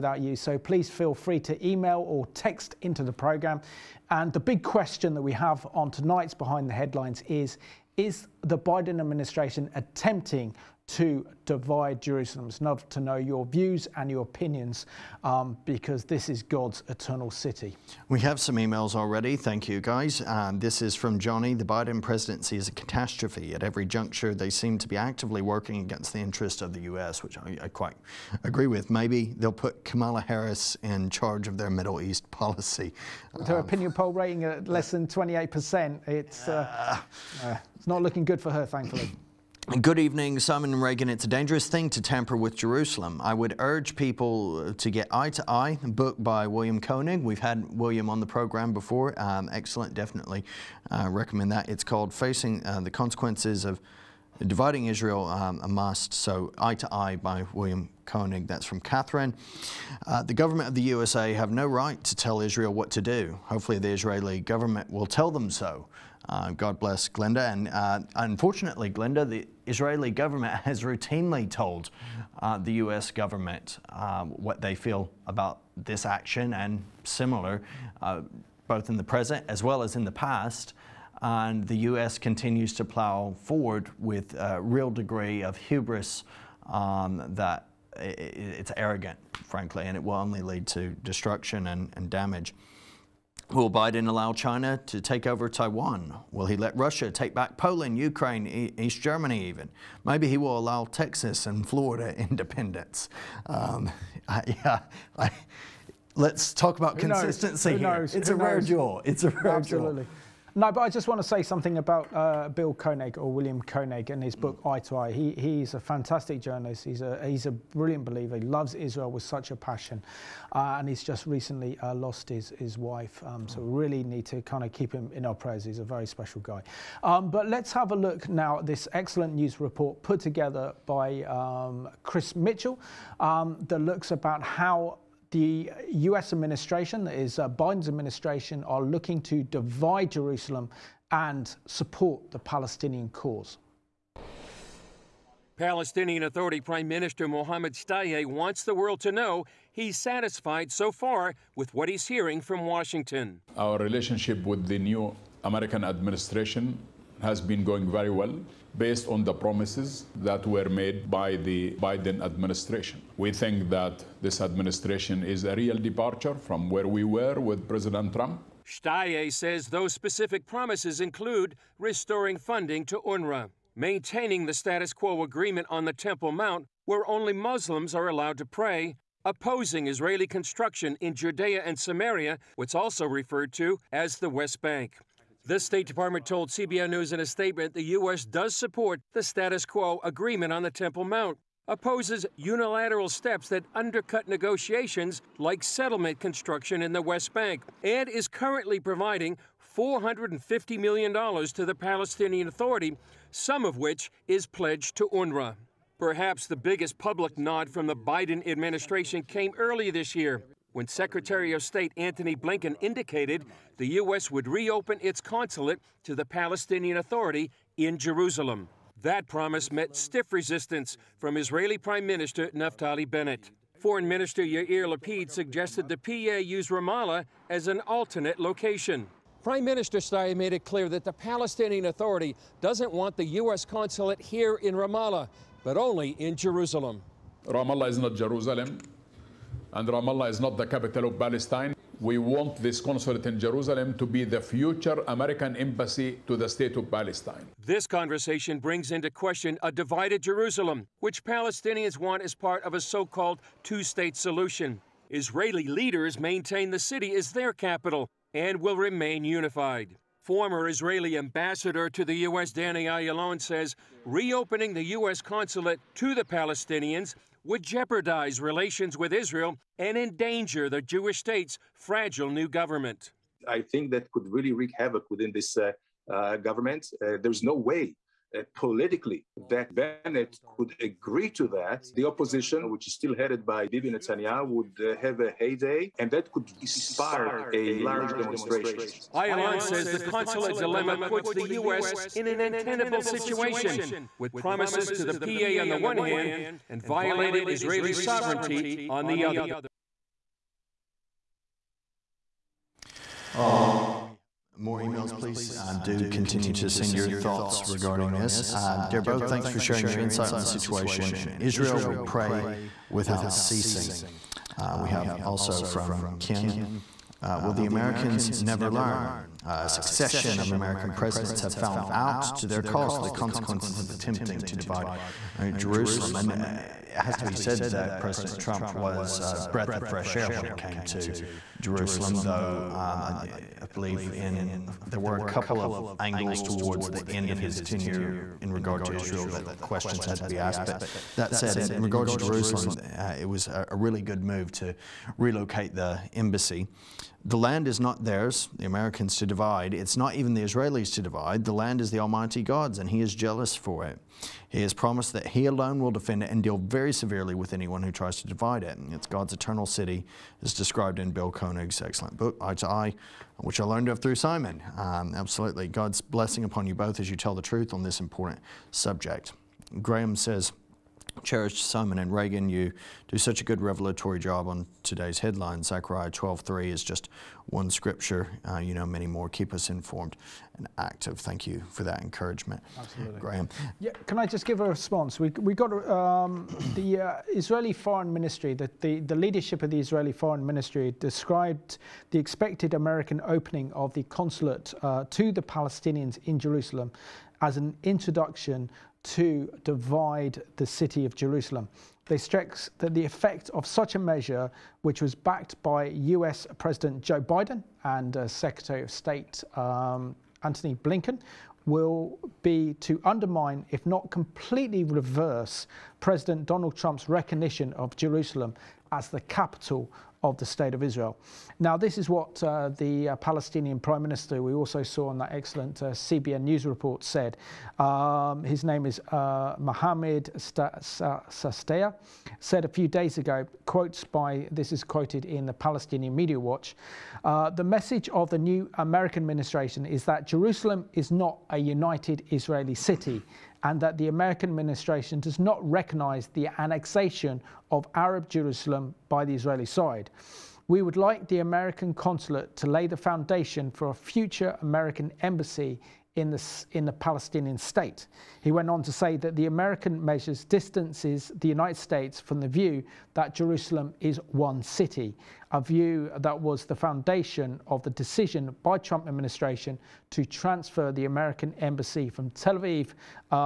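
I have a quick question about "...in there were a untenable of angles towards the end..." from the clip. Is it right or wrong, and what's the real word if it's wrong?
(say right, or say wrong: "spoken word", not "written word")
wrong: "couple", not "untenable".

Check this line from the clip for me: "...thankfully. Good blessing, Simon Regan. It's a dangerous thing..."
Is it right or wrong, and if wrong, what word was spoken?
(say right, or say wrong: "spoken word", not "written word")
wrong: "evening", not "blessing".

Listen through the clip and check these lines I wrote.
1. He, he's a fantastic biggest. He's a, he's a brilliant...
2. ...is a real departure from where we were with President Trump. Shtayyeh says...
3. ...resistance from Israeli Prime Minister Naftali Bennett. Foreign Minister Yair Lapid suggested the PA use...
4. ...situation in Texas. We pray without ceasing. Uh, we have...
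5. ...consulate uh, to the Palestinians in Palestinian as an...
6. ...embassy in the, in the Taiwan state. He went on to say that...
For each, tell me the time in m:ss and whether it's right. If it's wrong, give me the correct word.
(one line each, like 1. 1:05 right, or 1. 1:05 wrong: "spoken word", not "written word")
1. 1:55 wrong: "journalist", not "biggest"
2. 2:45 right
3. 3:40 right
4. 5:10 wrong: "Israel", not "Texas"
5. 6:34 wrong: "Jerusalem", not "Palestinian"
6. 7:35 wrong: "Palestinian", not "Taiwan".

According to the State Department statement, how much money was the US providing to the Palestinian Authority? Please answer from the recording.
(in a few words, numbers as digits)
$450 million.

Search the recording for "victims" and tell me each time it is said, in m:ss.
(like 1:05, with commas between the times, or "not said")
not said.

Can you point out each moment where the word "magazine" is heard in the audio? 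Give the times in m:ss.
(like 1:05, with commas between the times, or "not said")
not said.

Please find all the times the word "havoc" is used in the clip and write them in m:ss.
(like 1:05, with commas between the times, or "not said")
4:34.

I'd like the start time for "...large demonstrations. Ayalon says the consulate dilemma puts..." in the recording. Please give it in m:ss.
4:47.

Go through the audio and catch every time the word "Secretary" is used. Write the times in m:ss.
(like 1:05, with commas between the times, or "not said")
3:30, 6:48.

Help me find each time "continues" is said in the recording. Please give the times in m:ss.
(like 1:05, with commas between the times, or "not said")
1:22, 5:06.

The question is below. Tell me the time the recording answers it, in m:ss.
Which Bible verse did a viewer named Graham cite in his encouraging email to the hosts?
6:15.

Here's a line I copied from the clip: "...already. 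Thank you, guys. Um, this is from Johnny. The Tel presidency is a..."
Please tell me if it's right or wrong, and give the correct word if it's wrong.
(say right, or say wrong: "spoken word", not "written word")
wrong: "Biden", not "Tel".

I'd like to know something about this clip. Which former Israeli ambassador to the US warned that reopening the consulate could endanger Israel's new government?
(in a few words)
Danny Ayalon.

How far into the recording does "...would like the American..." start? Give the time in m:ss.
7:30.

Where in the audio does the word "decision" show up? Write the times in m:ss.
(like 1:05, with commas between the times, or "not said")
7:47.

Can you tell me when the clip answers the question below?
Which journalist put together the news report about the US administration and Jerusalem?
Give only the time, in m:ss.
2:12.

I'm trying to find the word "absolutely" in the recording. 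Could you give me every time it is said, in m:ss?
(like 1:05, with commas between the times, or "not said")
1:49, 6:05, 6:22.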